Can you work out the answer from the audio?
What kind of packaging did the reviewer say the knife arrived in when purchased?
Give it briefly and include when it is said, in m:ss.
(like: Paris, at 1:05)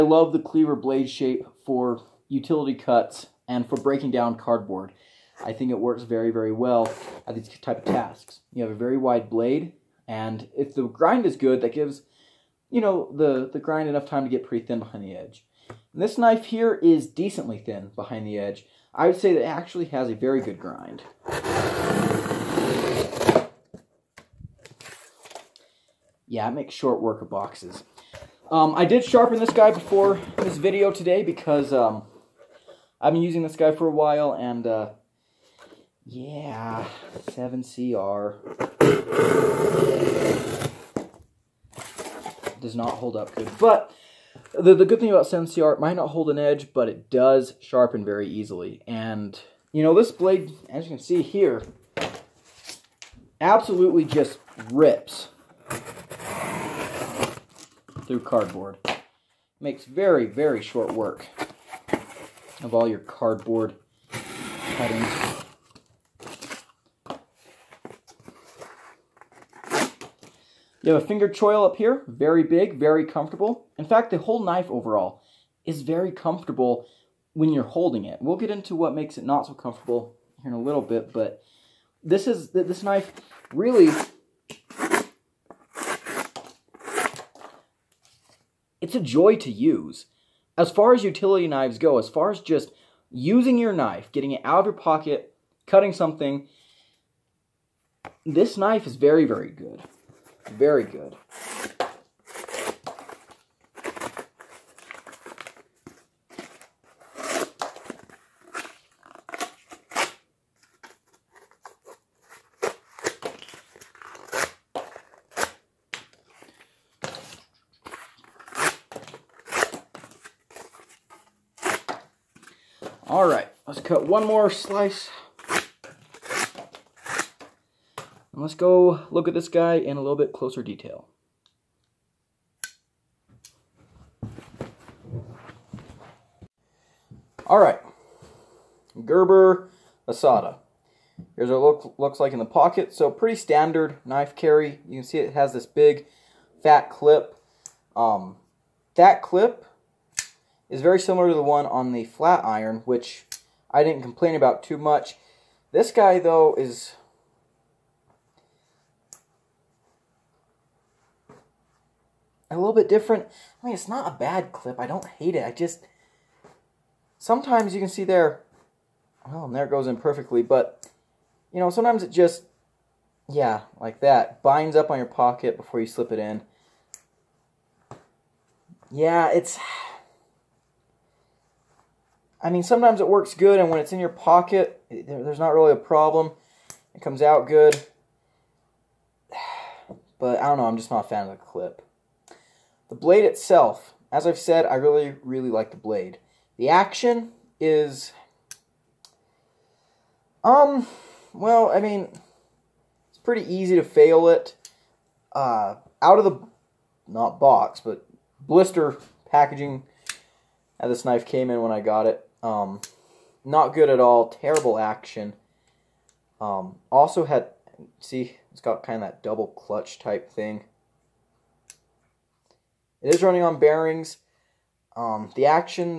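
Blister packaging, at 3:28.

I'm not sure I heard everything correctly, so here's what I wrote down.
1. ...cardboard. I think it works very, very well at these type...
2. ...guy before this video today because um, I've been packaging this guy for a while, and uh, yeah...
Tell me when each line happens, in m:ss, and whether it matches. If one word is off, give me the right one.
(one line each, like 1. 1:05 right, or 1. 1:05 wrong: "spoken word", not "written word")
1. 0:04 right
2. 0:29 wrong: "using", not "packaging".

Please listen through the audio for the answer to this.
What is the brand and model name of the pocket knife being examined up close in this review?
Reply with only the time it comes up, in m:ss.
2:19.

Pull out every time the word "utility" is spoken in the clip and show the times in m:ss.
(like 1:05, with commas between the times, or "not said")
0:02, 1:31.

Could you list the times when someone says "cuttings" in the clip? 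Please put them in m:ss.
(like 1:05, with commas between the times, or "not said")
1:04, 1:35.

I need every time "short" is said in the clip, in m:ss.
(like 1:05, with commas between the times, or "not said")
0:26, 1:00.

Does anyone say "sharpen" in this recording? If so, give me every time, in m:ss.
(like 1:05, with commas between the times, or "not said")
0:29, 0:47.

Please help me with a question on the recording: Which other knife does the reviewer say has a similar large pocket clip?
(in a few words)
Flat Iron.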